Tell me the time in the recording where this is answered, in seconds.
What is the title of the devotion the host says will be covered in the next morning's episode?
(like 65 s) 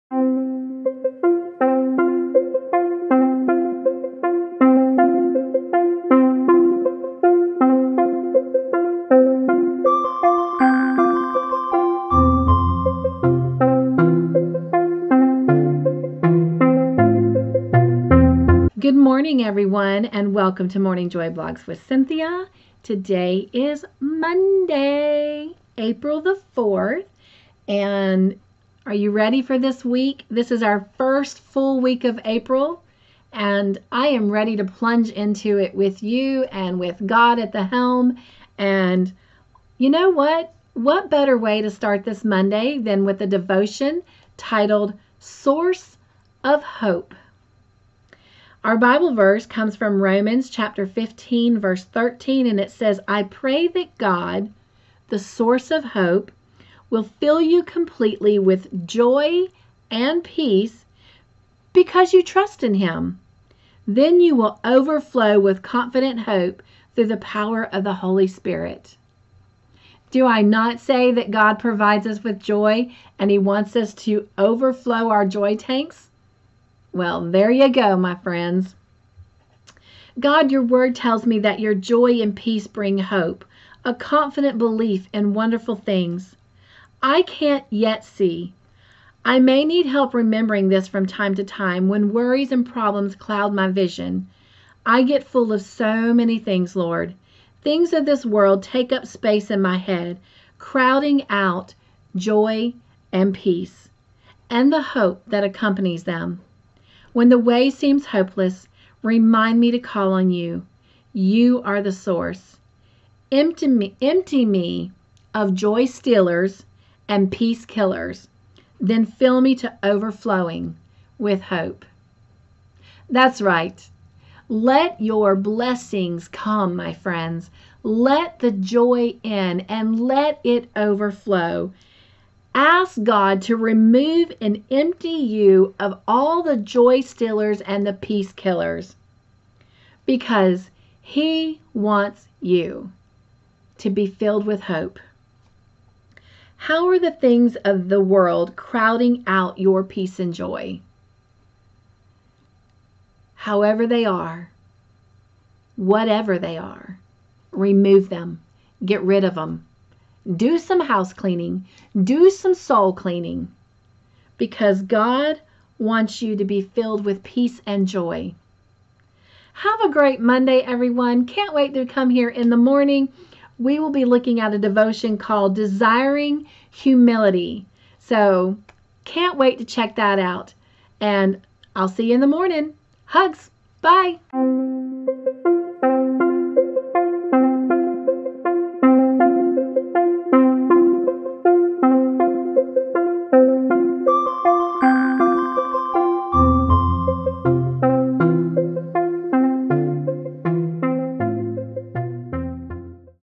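175 s.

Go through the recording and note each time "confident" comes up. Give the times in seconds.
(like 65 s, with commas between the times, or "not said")
65 s, 83 s.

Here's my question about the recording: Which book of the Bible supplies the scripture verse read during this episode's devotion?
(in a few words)
Romans.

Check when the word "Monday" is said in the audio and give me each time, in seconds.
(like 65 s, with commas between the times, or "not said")
24 s, 42 s, 170 s.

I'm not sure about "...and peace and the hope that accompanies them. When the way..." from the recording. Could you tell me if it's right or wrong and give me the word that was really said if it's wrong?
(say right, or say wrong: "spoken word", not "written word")
right.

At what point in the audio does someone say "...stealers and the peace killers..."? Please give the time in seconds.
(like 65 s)
136 s.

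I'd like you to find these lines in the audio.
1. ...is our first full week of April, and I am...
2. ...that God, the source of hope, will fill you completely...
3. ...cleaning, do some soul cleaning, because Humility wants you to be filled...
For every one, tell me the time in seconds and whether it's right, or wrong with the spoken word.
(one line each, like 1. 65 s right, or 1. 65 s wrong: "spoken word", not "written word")
1. 30 s right
2. 53 s right
3. 161 s wrong: "God", not "Humility".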